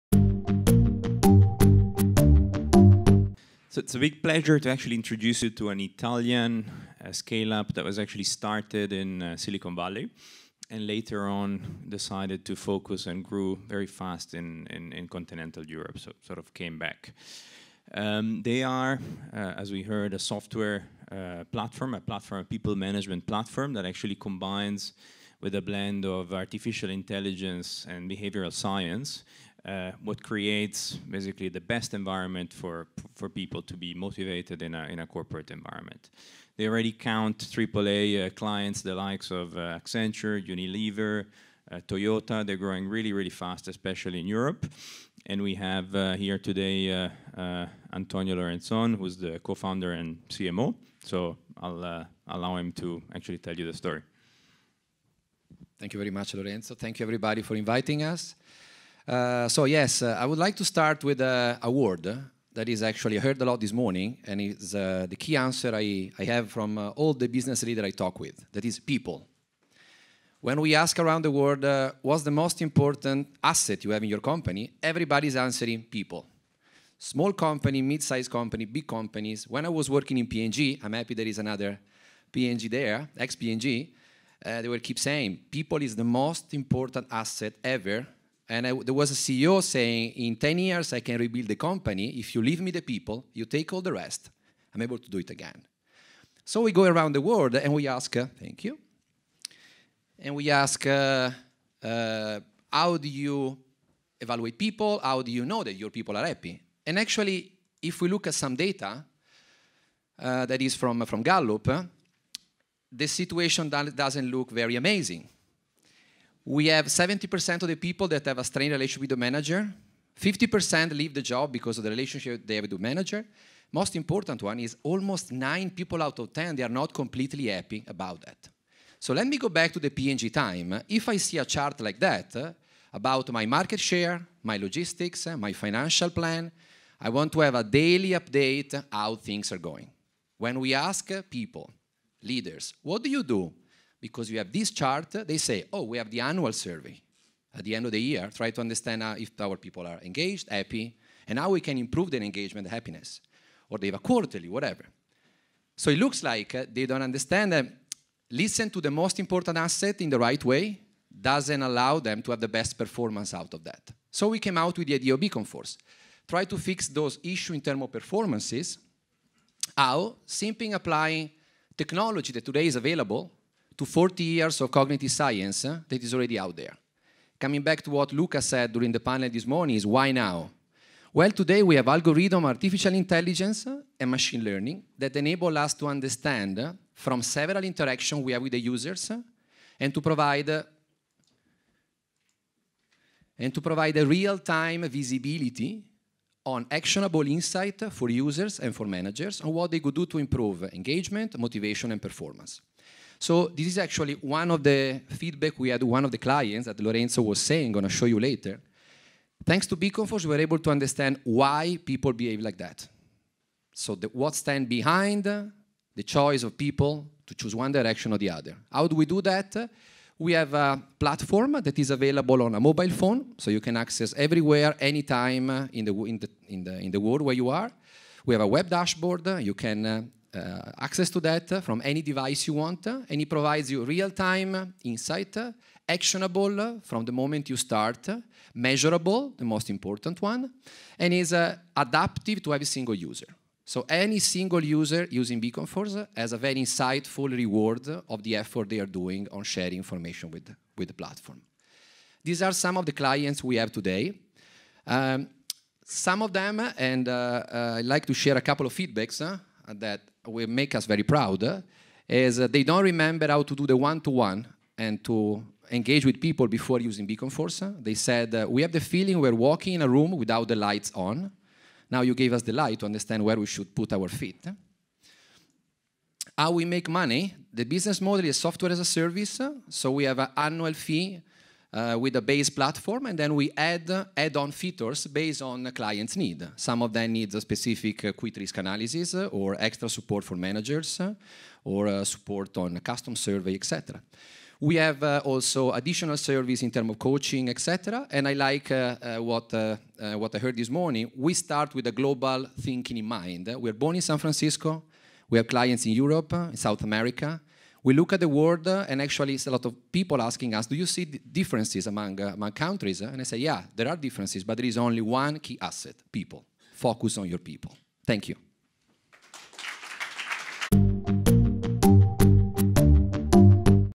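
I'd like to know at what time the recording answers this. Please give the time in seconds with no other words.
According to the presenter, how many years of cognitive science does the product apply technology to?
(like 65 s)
173 s.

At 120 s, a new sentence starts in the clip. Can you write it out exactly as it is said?
50% leave the job because of the relationship they have with the manager.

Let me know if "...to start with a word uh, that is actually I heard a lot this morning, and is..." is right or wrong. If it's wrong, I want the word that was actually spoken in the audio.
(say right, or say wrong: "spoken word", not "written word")
right.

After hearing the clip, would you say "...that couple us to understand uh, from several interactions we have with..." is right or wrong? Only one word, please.
wrong.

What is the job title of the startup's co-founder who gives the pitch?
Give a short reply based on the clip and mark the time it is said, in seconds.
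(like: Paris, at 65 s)
CMO, at 50 s.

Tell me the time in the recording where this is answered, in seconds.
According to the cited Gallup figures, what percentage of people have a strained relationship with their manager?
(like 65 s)
116 s.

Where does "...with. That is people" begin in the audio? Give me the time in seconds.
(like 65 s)
68 s.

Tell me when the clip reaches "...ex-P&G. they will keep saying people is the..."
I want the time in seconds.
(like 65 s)
83 s.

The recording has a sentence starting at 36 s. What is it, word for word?
They already count AAA uh, clients, the likes of uh, Accenture, Unilever, uh, Toyota.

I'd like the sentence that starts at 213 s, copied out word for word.
So the, what stands behind the choice of people to choose one direction or the other.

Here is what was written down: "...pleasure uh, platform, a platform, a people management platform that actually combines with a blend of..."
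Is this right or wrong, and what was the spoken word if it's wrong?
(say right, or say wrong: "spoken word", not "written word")
wrong: "software", not "pleasure".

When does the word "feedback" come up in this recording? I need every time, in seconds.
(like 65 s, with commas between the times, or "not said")
205 s, 258 s.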